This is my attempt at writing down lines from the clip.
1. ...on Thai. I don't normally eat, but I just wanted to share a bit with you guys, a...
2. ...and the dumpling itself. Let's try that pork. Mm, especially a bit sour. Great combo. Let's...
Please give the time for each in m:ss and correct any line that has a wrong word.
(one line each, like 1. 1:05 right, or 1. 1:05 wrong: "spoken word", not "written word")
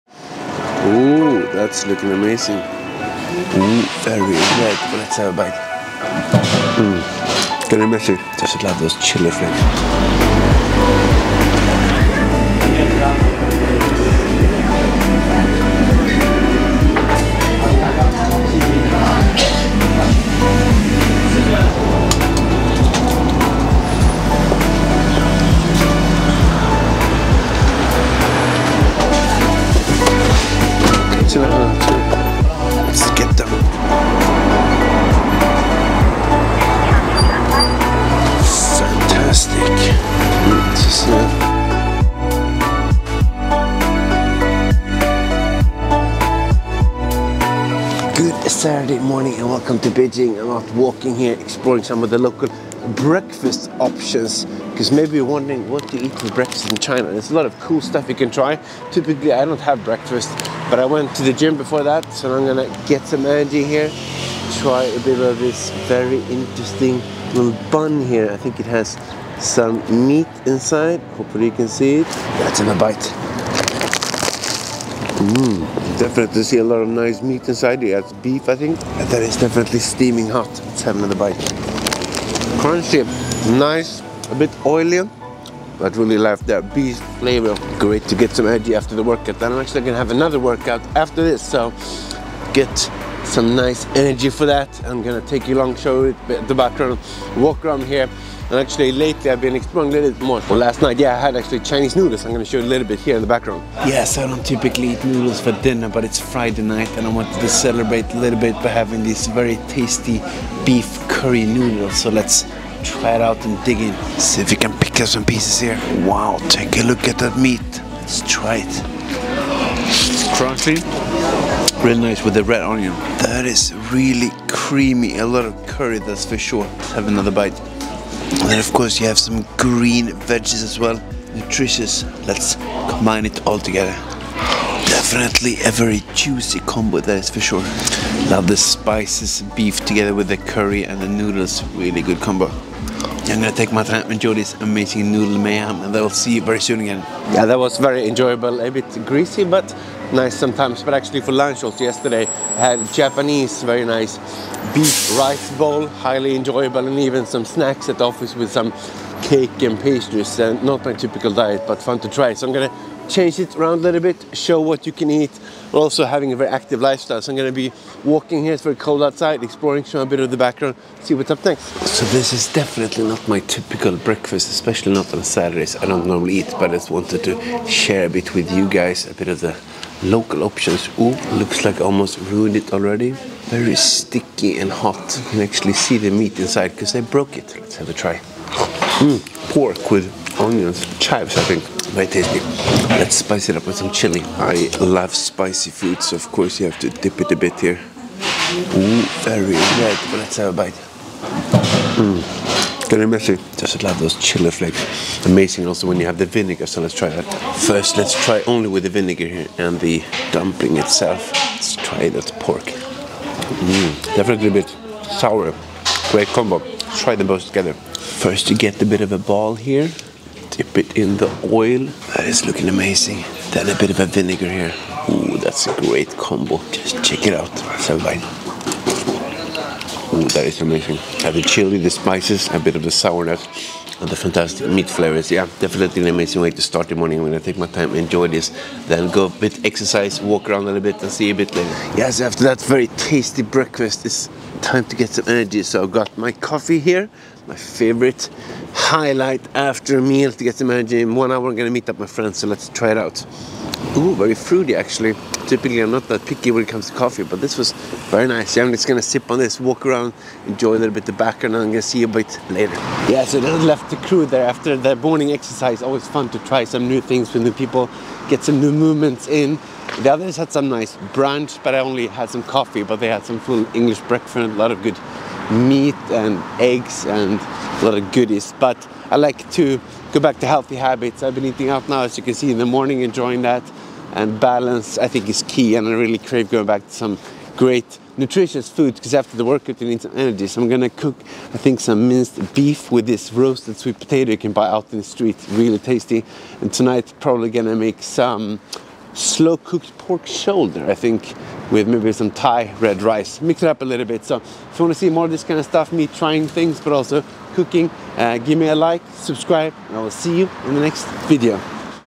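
1. 2:55 wrong: "Saturdays", not "Thai"
2. 3:29 wrong: "definitely", not "especially".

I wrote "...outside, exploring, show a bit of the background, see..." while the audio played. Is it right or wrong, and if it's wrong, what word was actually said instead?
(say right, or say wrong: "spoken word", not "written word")
right.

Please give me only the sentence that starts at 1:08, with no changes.
I think it has some meat inside.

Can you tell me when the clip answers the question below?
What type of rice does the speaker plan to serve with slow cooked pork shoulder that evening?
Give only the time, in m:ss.
5:02.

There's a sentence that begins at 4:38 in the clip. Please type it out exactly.
But I like to go back to healthy habits.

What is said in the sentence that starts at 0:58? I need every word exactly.
Typically I don't have breakfast but I went to the gym before that so I'm gonna get some energy here.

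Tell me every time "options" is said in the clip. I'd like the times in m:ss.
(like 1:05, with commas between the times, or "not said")
0:53, 3:00.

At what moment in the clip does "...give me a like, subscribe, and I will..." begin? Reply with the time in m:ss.
5:08.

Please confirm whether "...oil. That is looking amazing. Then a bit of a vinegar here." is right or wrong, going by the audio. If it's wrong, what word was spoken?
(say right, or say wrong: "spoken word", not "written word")
right.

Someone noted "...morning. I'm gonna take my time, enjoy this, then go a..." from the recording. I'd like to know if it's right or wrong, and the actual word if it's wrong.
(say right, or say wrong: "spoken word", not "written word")
right.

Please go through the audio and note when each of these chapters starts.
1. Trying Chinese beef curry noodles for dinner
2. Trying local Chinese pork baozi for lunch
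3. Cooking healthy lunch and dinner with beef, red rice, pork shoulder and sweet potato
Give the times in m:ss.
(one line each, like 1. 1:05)
1. 1:44
2. 2:53
3. 4:45.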